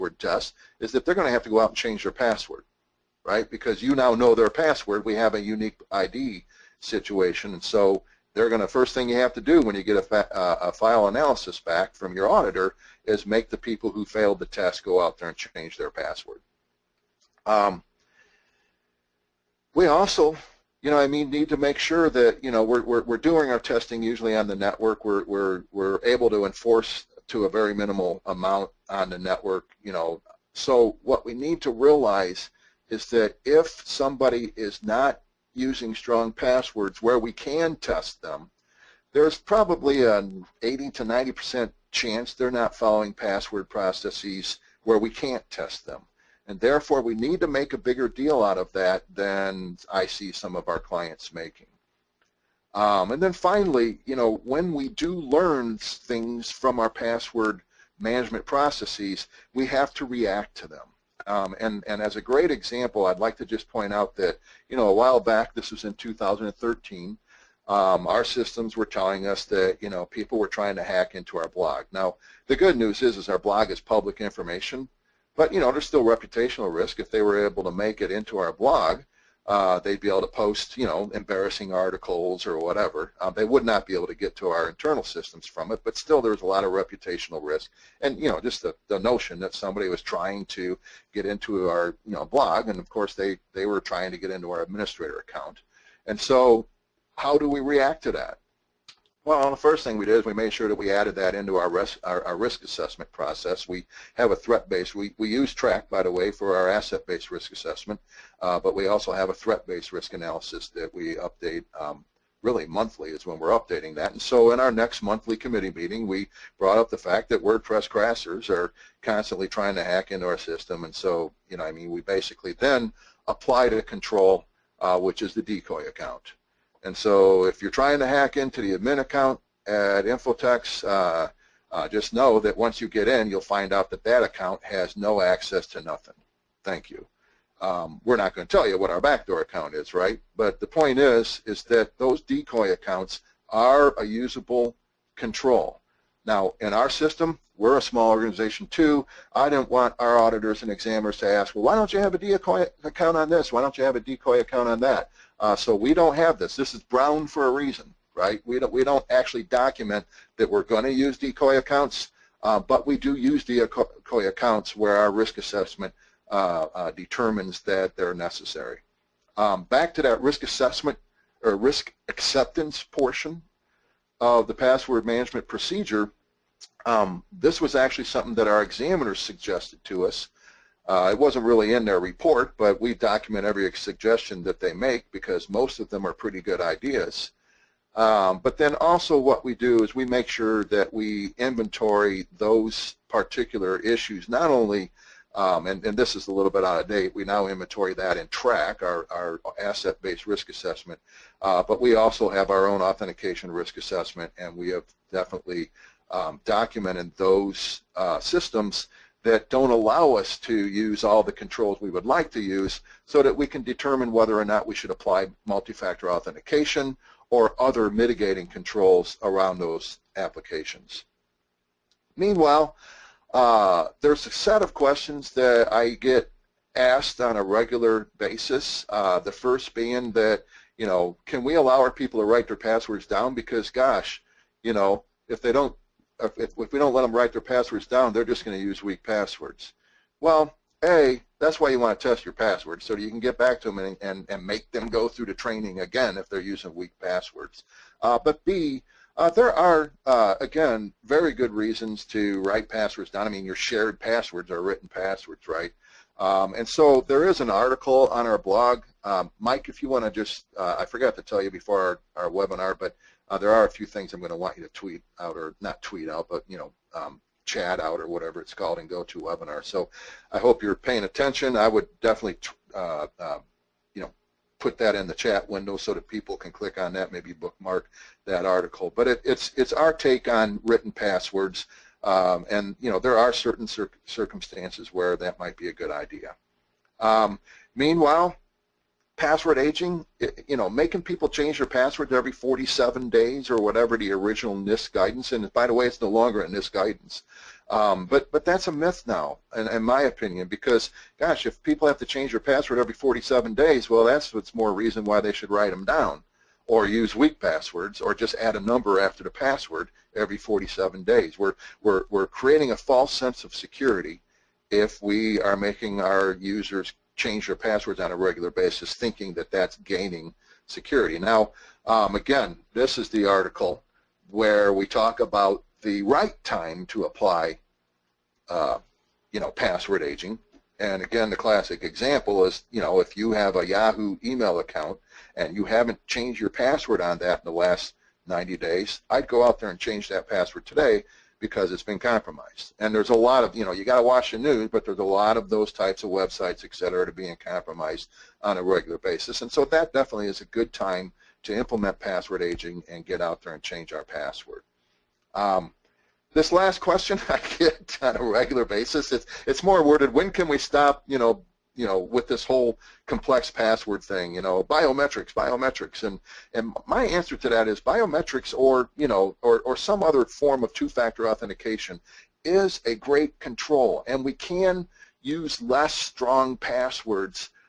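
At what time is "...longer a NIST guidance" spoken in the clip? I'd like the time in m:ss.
4:56.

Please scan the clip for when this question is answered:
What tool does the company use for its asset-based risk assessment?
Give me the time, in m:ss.
1:45.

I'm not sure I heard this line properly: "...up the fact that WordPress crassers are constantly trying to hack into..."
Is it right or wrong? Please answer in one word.
right.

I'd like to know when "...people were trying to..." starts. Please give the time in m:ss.
1:10.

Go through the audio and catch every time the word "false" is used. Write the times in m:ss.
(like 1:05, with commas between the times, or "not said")
5:12.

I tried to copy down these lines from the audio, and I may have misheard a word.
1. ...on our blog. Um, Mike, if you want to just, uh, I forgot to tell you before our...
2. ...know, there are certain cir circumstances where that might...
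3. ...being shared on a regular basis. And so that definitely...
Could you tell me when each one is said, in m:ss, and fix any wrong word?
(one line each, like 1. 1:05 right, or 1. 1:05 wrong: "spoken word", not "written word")
1. 4:18 right
2. 4:42 right
3. 5:47 wrong: "compromised", not "shared".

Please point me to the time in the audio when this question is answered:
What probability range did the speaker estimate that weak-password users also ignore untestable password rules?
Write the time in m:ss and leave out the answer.
0:40.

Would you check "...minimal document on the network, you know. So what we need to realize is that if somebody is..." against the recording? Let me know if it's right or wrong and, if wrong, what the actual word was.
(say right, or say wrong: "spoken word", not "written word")
wrong: "amount", not "document".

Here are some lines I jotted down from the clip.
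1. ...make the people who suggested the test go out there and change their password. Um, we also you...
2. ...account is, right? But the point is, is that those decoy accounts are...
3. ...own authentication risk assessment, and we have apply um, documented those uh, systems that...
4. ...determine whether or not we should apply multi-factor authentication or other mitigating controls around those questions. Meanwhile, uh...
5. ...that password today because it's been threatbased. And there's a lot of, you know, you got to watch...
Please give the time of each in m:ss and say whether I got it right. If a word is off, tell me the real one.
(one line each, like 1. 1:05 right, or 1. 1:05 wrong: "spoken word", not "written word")
1. 0:13 wrong: "failed", not "suggested"
2. 2:19 right
3. 3:22 wrong: "definitely", not "apply"
4. 3:33 wrong: "applications", not "questions"
5. 5:40 wrong: "compromised", not "threatbased".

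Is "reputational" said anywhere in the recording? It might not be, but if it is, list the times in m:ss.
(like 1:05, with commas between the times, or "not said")
1:16, 1:26.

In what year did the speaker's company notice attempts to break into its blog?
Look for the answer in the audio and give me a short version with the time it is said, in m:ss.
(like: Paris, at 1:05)
2013, at 1:05.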